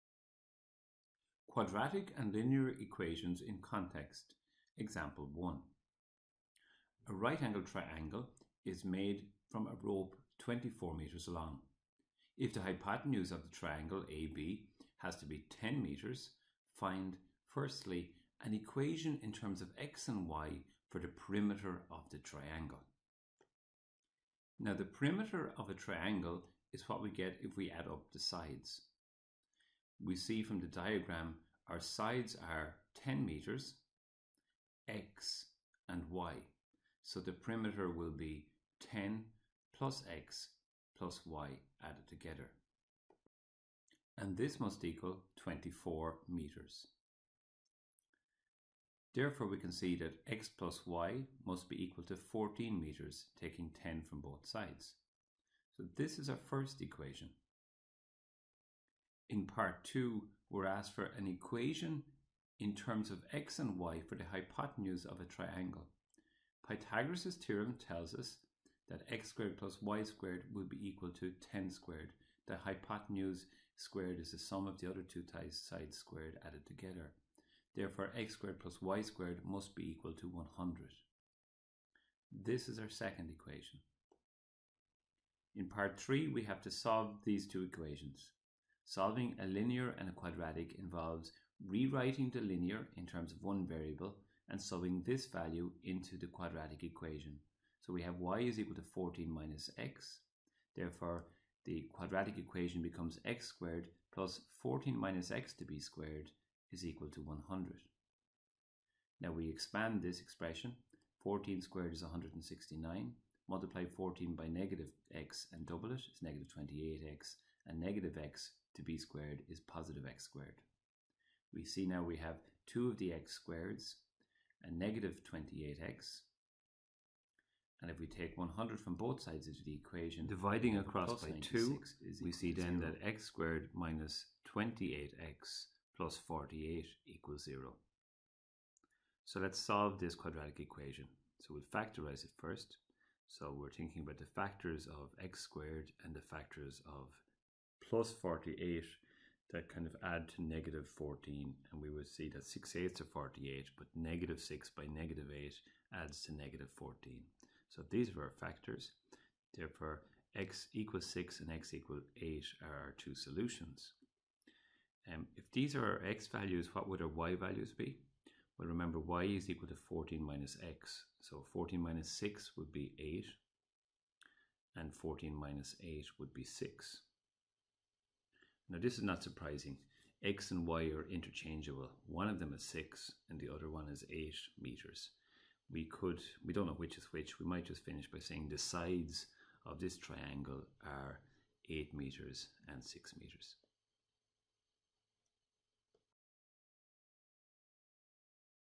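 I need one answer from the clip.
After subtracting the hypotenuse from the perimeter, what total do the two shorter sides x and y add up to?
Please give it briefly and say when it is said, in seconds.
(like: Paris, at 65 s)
14 meters, at 52 s.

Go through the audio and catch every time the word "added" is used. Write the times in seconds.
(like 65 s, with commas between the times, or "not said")
41 s, 76 s.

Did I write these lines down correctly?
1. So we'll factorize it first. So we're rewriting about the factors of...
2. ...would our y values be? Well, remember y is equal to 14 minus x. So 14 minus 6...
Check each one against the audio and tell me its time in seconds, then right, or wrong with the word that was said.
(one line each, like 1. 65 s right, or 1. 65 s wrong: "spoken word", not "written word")
1. 141 s wrong: "thinking", not "rewriting"
2. 166 s right.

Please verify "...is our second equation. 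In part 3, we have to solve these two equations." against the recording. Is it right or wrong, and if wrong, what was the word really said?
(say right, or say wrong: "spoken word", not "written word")
right.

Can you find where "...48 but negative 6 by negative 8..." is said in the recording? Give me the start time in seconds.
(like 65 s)
153 s.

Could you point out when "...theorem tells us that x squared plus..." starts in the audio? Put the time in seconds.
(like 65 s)
67 s.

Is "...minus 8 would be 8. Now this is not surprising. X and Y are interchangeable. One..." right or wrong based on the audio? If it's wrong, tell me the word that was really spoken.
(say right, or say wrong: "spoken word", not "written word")
wrong: "6", not "8".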